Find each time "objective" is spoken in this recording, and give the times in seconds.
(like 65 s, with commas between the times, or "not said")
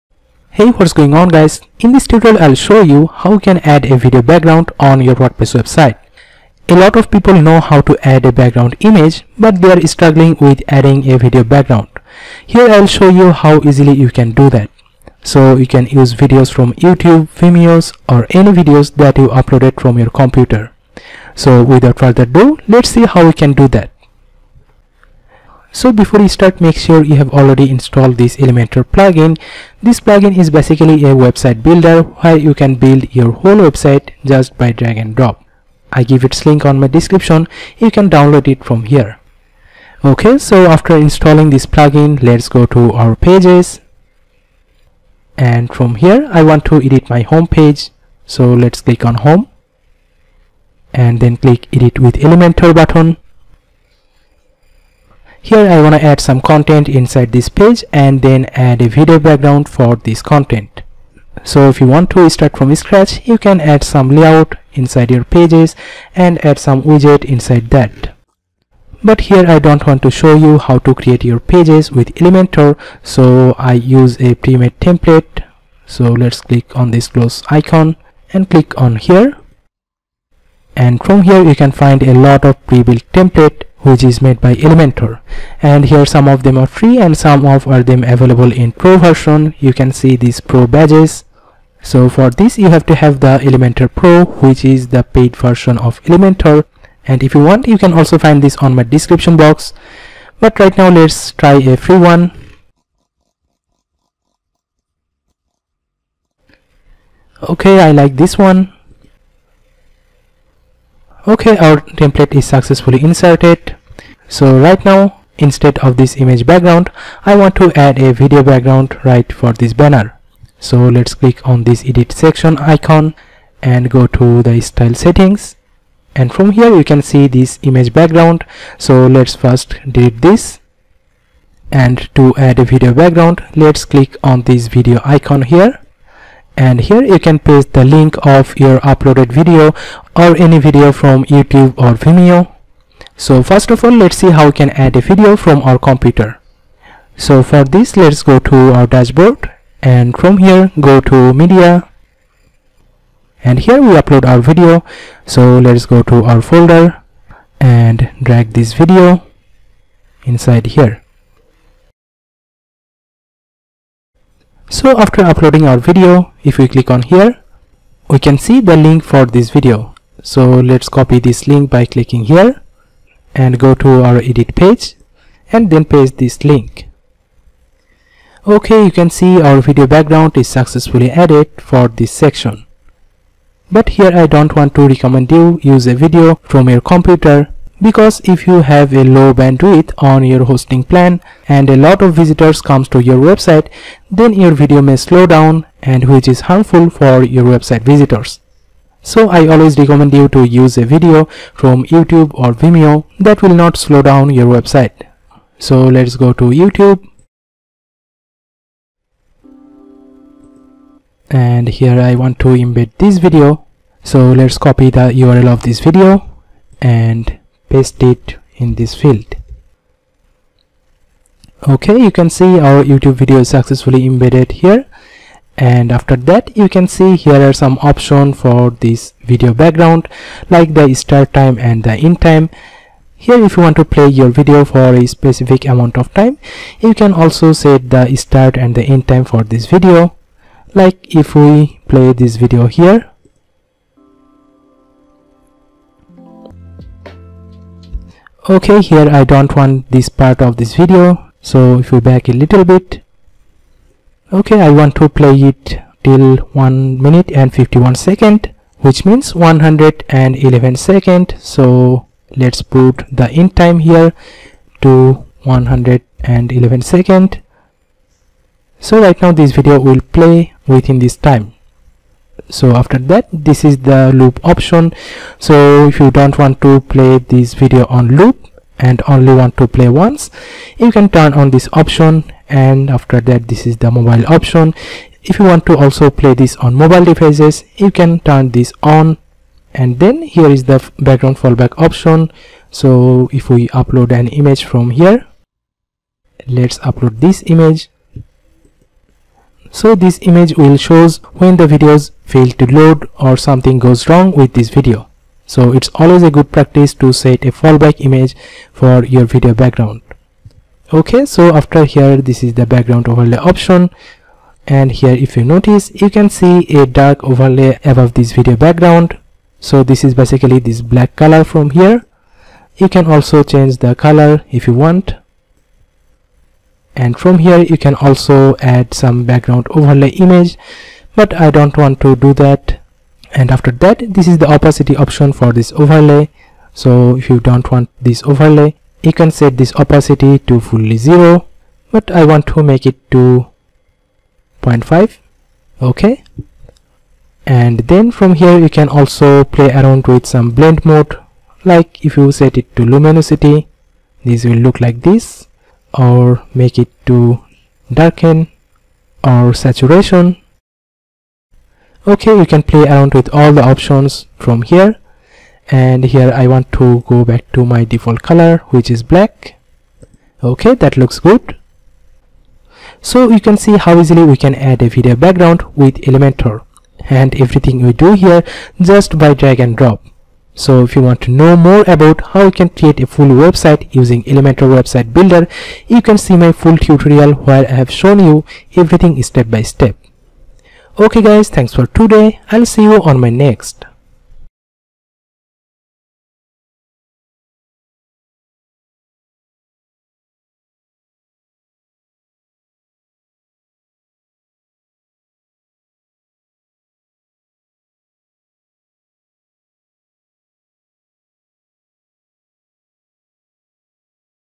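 not said.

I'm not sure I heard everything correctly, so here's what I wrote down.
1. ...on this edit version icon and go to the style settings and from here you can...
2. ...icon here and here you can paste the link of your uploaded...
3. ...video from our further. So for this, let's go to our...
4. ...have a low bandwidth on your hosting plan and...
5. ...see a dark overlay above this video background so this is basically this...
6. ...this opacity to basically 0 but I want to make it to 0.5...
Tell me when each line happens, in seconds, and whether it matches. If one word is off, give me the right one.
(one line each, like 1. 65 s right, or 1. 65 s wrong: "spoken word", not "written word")
1. 121 s wrong: "section", not "version"
2. 135 s right
3. 145 s wrong: "computer", not "further"
4. 188 s right
5. 316 s right
6. 339 s wrong: "fully", not "basically".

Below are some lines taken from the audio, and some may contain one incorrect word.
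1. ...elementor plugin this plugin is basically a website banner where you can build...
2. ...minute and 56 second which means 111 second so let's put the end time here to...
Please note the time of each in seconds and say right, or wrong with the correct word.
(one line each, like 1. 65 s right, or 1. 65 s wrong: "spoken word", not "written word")
1. 28 s wrong: "builder", not "banner"
2. 257 s wrong: "51", not "56".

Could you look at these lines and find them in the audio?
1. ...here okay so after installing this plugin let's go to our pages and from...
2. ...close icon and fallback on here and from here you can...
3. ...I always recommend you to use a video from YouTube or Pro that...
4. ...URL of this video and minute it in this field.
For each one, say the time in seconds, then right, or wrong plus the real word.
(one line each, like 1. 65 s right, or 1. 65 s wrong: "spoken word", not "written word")
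1. 38 s right
2. 77 s wrong: "click", not "fallback"
3. 199 s wrong: "Vimeo", not "Pro"
4. 215 s wrong: "paste", not "minute".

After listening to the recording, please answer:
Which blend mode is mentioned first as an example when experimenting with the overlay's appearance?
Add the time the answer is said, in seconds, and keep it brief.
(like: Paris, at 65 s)
luminosity, at 352 s.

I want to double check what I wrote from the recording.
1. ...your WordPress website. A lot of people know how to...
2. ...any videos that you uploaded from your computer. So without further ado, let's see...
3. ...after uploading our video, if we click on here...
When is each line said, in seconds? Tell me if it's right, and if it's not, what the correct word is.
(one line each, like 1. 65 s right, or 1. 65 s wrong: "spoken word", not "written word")
1. 5 s right
2. 18 s right
3. 164 s right.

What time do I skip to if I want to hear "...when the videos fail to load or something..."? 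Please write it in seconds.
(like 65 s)
301 s.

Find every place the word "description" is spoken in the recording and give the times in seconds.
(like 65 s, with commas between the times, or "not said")
36 s, 98 s.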